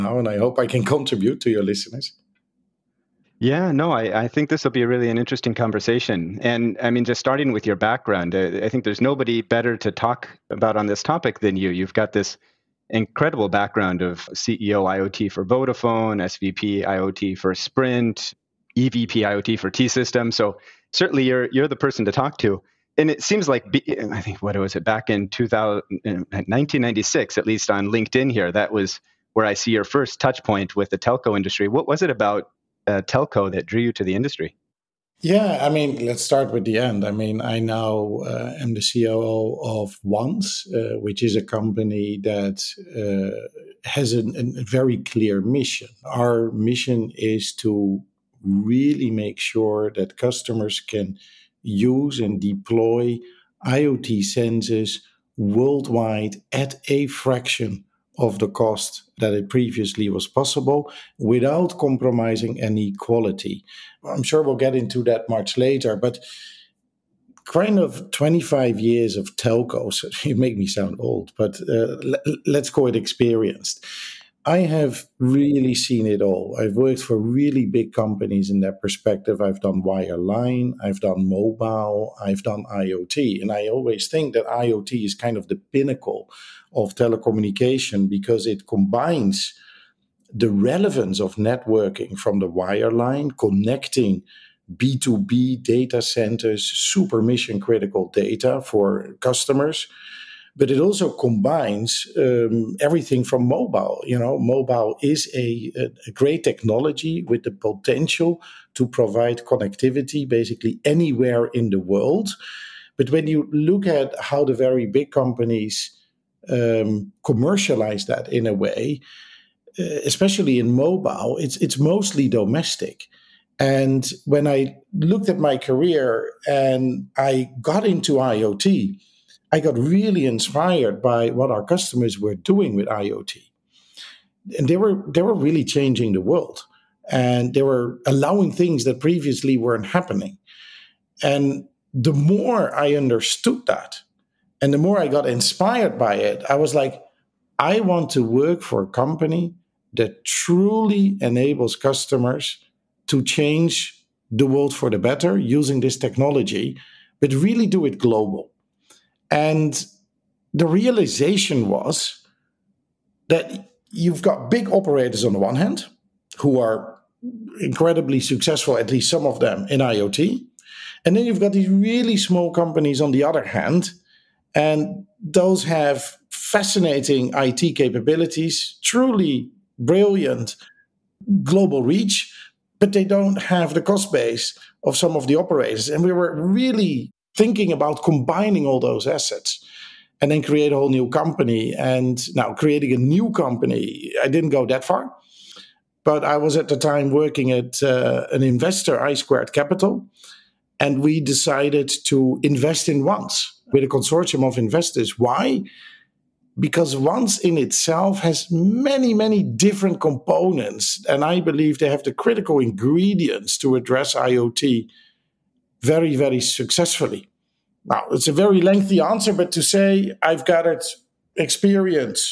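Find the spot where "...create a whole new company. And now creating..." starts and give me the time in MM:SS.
03:10.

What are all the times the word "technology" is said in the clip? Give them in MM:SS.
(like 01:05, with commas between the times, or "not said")
01:46, 02:35.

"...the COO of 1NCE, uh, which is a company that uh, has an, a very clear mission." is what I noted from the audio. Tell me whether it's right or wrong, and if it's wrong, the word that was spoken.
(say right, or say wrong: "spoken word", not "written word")
right.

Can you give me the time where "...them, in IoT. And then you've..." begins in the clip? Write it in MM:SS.
02:49.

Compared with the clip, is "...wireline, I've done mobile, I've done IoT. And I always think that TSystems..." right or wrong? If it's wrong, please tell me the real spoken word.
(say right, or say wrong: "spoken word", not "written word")
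wrong: "IoT", not "TSystems".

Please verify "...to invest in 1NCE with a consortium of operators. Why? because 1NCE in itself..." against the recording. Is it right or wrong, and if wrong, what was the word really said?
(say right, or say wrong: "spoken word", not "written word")
wrong: "investors", not "operators".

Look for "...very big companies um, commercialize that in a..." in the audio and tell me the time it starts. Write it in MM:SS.
01:54.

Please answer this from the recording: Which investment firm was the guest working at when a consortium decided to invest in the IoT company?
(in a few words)
I Squared Capital.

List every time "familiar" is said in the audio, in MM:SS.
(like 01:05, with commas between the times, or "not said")
not said.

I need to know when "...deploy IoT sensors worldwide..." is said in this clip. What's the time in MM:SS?
00:52.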